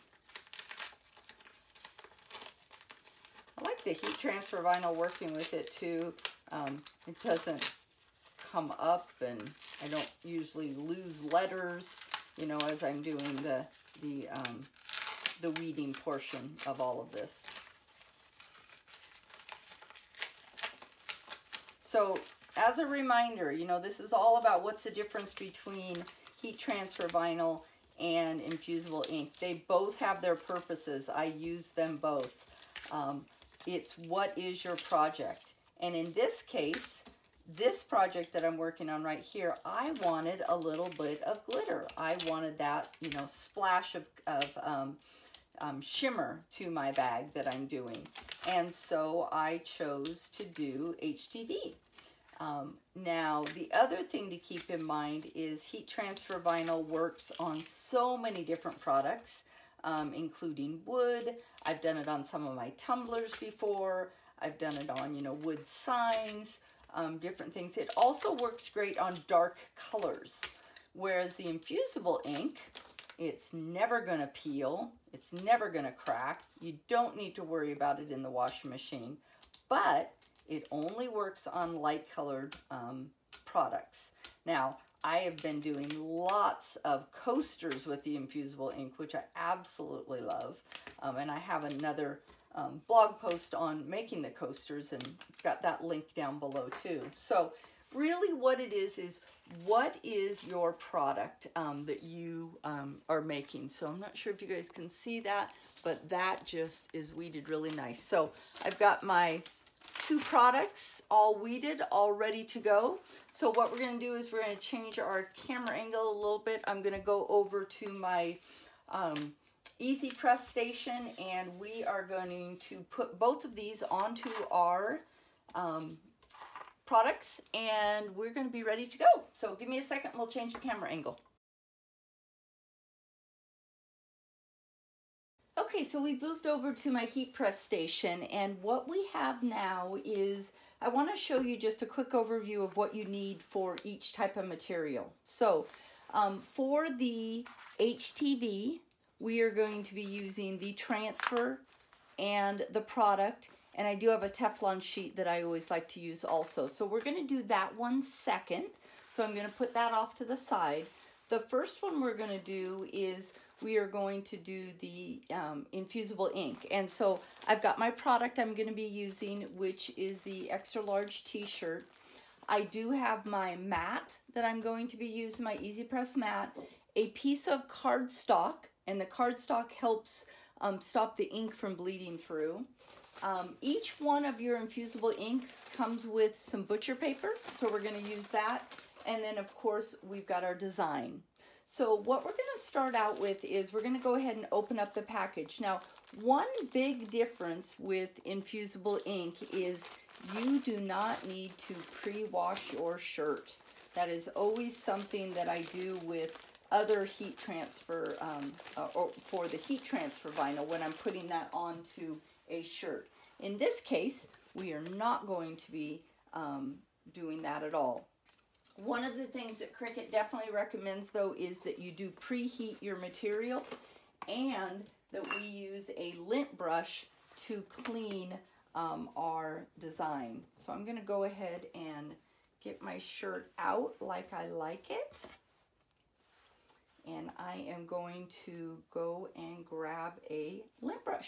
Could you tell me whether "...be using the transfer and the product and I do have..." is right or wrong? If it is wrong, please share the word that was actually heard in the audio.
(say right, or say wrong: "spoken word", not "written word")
right.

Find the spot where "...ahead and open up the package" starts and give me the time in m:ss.
3:14.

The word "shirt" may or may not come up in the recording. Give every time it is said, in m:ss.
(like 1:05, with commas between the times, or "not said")
2:51, 3:22, 3:32, 3:52.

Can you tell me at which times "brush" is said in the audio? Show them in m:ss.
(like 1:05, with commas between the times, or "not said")
3:46.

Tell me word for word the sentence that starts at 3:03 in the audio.
Um, each one of your infusible inks comes with some butcher paper, so we're going to use that.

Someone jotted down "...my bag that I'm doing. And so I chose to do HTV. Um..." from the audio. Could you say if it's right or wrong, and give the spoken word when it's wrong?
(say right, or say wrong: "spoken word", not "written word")
right.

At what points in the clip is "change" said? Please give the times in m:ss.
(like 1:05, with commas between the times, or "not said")
1:54, 2:10.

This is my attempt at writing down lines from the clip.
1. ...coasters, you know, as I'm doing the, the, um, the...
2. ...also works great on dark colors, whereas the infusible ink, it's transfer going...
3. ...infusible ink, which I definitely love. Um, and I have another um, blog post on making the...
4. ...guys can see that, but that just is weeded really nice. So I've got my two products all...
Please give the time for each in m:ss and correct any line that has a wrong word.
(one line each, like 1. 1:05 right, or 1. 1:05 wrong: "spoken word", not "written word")
1. 0:11 wrong: "letters", not "coasters"
2. 1:07 wrong: "never", not "transfer"
3. 1:28 wrong: "absolutely", not "definitely"
4. 1:44 right.